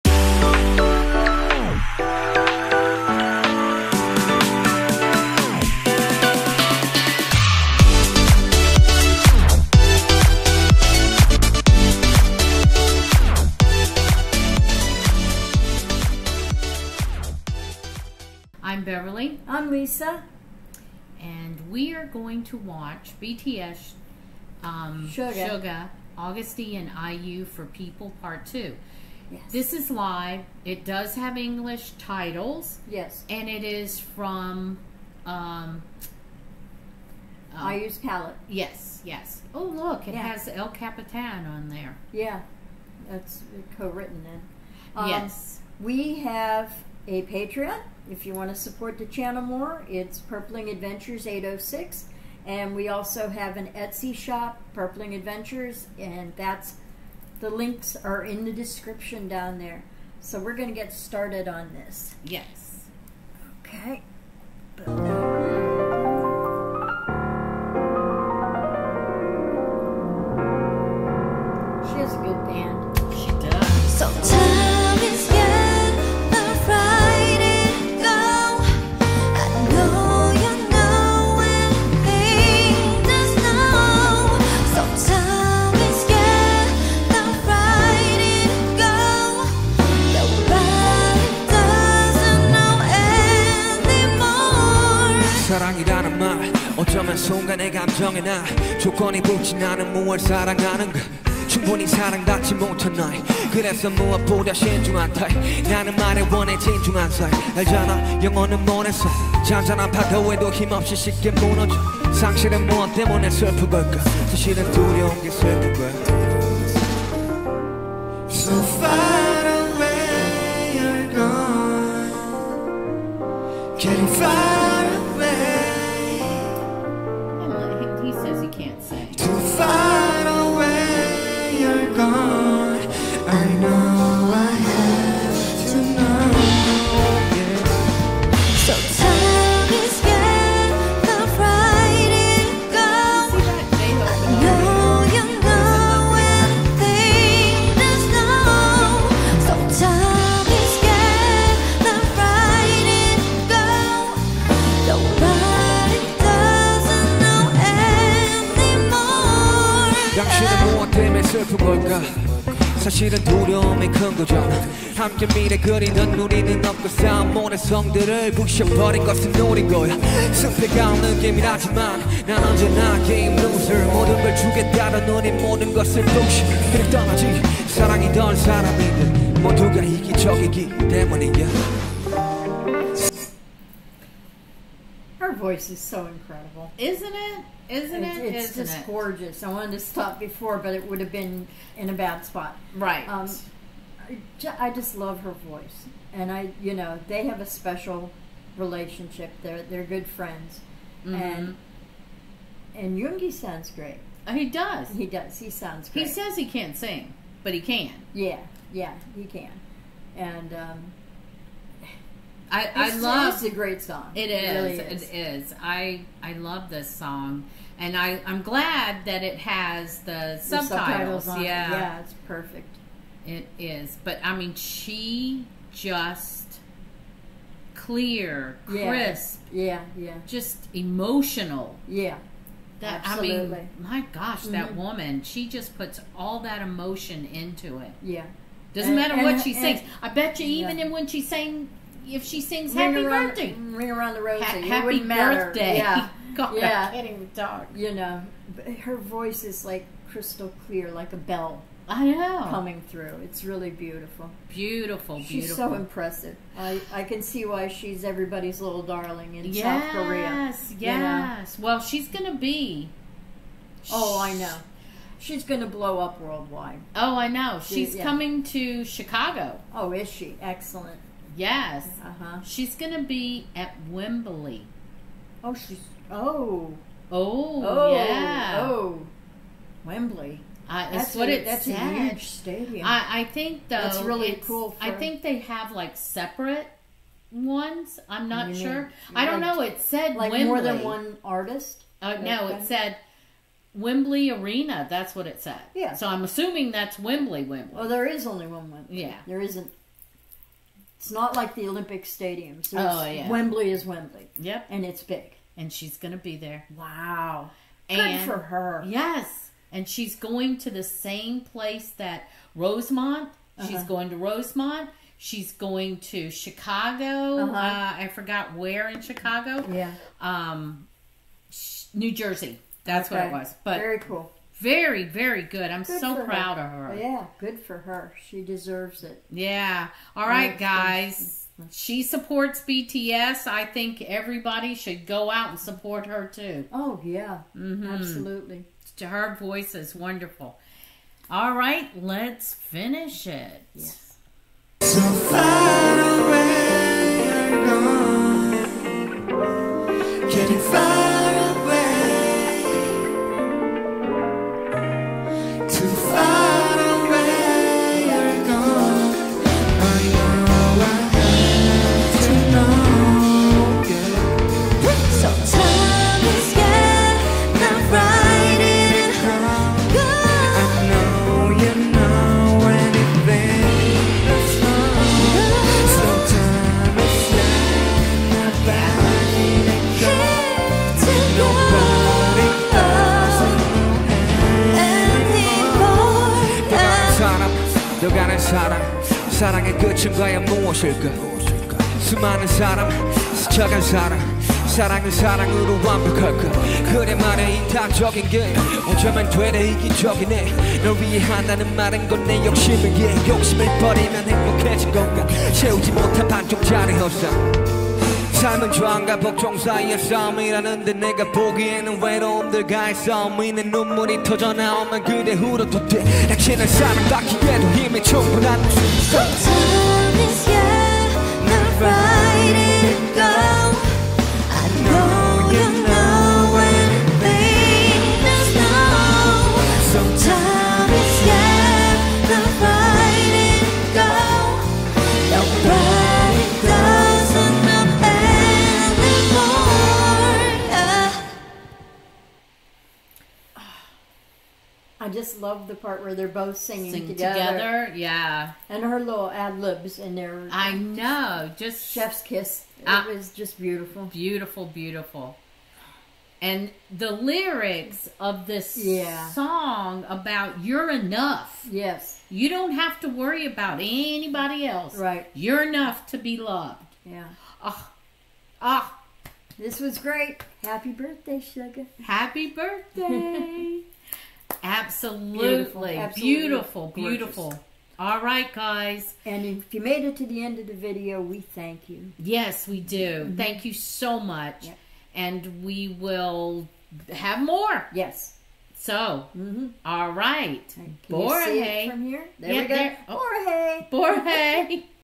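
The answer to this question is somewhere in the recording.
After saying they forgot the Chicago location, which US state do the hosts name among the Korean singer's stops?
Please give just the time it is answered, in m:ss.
5:21.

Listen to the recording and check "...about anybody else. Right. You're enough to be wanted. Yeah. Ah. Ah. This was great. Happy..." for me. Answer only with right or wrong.
wrong.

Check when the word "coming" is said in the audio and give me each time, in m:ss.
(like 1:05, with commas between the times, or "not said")
4:12, 4:28.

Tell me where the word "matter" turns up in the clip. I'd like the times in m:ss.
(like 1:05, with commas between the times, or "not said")
3:59.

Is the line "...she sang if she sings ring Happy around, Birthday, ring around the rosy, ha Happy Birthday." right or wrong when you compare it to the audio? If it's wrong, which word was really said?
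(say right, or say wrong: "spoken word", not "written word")
right.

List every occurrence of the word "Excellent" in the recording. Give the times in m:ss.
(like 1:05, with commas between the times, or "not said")
4:30.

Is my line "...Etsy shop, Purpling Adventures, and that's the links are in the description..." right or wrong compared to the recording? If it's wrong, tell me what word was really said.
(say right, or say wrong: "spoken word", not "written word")
right.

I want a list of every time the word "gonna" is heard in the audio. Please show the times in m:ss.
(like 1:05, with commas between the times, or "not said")
4:22, 5:05.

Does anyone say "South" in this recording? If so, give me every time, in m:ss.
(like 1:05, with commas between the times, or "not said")
4:19.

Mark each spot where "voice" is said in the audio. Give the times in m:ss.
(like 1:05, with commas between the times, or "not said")
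3:05, 3:15, 4:08, 5:39.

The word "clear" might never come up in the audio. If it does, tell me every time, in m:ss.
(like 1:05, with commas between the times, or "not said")
3:47, 4:10.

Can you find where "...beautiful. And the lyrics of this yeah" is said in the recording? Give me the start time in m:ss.
7:34.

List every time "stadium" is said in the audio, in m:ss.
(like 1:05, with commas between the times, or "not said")
4:42, 5:02.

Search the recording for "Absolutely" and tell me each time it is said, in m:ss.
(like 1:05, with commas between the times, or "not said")
3:53, 5:37, 7:54.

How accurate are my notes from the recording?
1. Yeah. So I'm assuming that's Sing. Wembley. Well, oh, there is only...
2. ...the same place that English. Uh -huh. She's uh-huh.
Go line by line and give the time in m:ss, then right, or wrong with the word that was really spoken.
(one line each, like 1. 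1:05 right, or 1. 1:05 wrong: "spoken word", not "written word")
1. 4:55 wrong: "Wembley", not "Sing"
2. 5:10 wrong: "Rosemont", not "English".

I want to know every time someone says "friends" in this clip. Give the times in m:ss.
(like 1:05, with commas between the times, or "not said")
3:20.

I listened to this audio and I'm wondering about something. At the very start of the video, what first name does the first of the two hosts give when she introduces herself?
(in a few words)
Beverly.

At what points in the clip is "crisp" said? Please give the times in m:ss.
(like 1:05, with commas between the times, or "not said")
3:48.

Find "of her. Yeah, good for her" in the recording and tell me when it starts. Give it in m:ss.
5:26.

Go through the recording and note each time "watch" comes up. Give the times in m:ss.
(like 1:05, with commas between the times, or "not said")
0:22.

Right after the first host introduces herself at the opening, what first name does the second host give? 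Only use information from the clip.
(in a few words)
Lisa.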